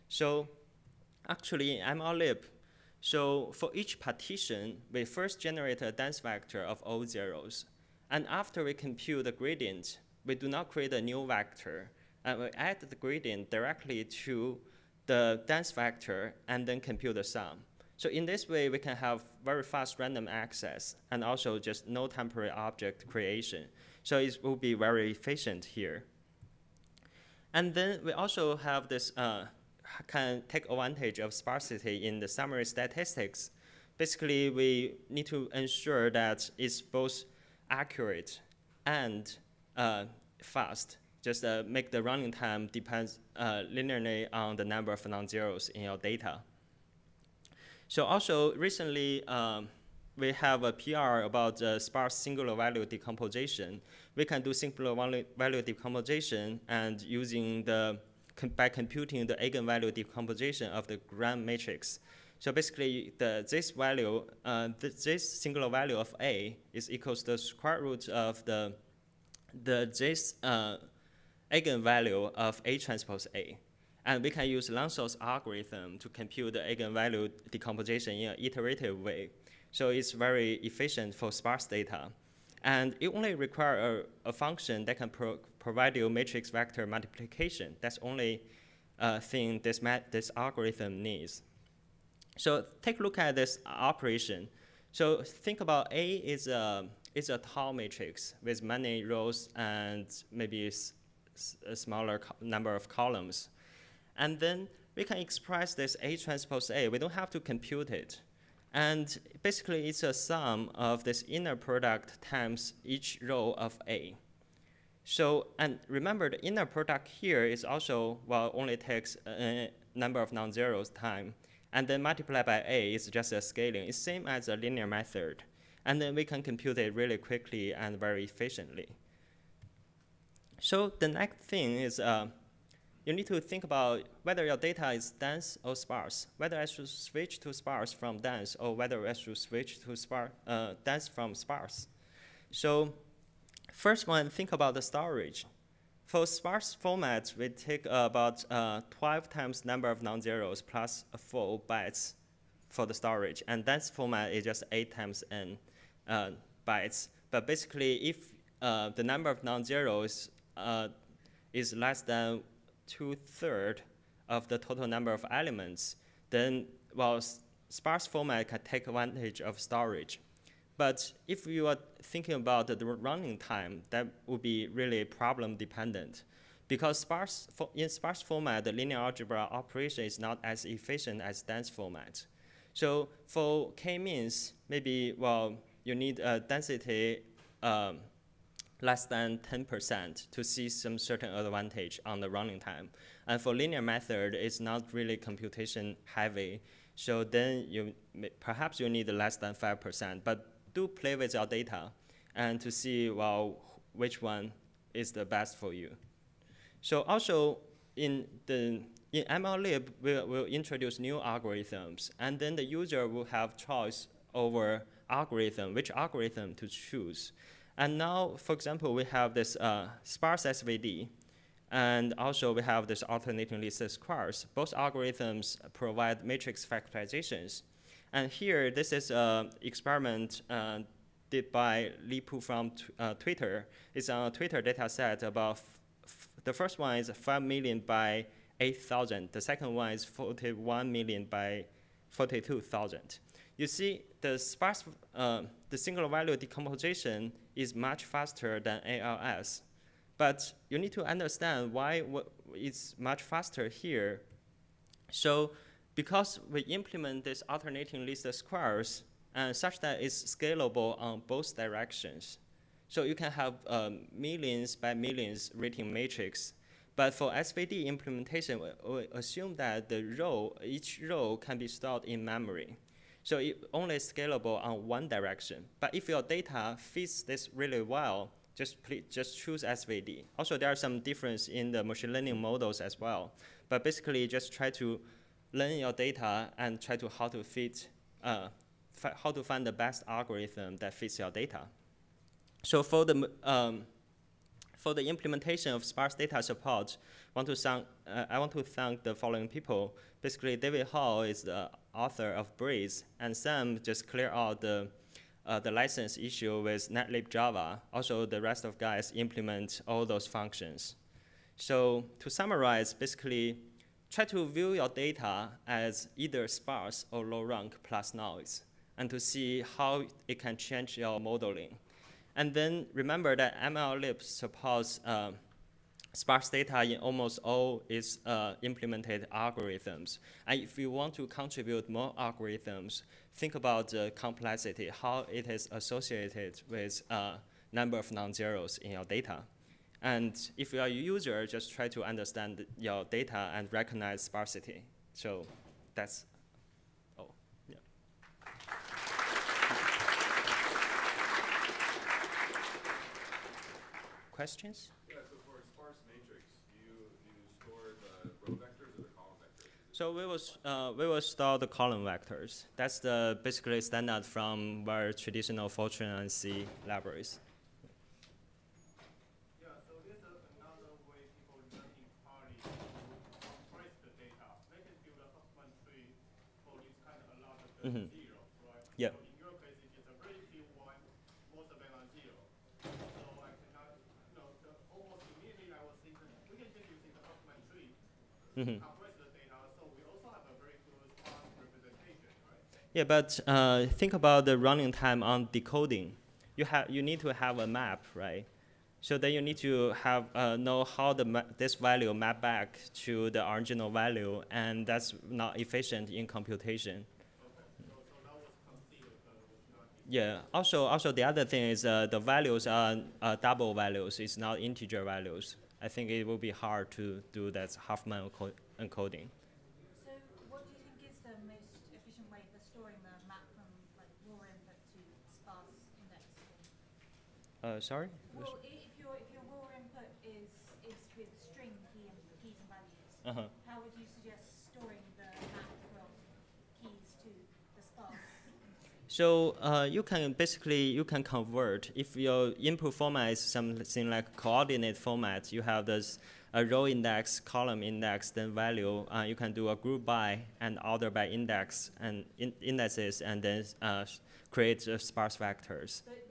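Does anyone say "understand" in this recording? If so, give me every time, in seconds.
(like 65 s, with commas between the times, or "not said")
251 s, 342 s.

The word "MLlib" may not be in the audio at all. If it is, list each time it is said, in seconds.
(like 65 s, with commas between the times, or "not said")
209 s, 323 s.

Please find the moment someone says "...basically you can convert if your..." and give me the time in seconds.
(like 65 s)
440 s.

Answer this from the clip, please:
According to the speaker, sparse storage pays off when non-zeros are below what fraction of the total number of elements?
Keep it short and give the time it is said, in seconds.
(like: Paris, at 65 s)
two-thirds, at 162 s.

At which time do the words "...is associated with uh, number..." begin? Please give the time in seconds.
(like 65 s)
335 s.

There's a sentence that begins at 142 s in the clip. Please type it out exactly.
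So First one, think about the storage.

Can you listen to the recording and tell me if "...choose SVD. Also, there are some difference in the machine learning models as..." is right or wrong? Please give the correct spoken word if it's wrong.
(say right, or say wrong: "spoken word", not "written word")
right.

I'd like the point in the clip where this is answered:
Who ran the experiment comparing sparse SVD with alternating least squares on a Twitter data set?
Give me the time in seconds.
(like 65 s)
232 s.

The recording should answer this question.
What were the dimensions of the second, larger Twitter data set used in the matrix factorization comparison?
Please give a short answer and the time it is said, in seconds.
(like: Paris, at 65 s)
41 million by 42,000, at 240 s.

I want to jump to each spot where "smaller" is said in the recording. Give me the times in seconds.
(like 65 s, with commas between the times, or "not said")
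101 s.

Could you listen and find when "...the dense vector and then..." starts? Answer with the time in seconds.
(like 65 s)
15 s.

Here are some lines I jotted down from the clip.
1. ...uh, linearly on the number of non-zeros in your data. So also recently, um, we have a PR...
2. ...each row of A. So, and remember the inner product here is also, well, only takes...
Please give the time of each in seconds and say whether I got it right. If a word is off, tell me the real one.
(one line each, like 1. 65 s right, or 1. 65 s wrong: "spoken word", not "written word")
1. 43 s right
2. 112 s right.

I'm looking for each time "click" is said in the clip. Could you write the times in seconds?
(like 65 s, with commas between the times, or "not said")
not said.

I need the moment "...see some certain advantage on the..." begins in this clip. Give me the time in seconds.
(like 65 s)
190 s.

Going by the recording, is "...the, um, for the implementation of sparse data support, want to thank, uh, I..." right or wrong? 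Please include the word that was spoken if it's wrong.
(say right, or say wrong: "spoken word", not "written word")
right.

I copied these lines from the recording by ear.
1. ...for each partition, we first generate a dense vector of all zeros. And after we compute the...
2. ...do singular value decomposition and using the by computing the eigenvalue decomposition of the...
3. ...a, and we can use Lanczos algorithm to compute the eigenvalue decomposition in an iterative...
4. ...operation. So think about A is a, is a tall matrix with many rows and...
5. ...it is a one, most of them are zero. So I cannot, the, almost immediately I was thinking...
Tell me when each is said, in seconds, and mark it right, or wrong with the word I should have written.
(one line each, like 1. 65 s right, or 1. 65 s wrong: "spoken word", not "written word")
1. 3 s right
2. 54 s right
3. 73 s right
4. 93 s right
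5. 379 s right.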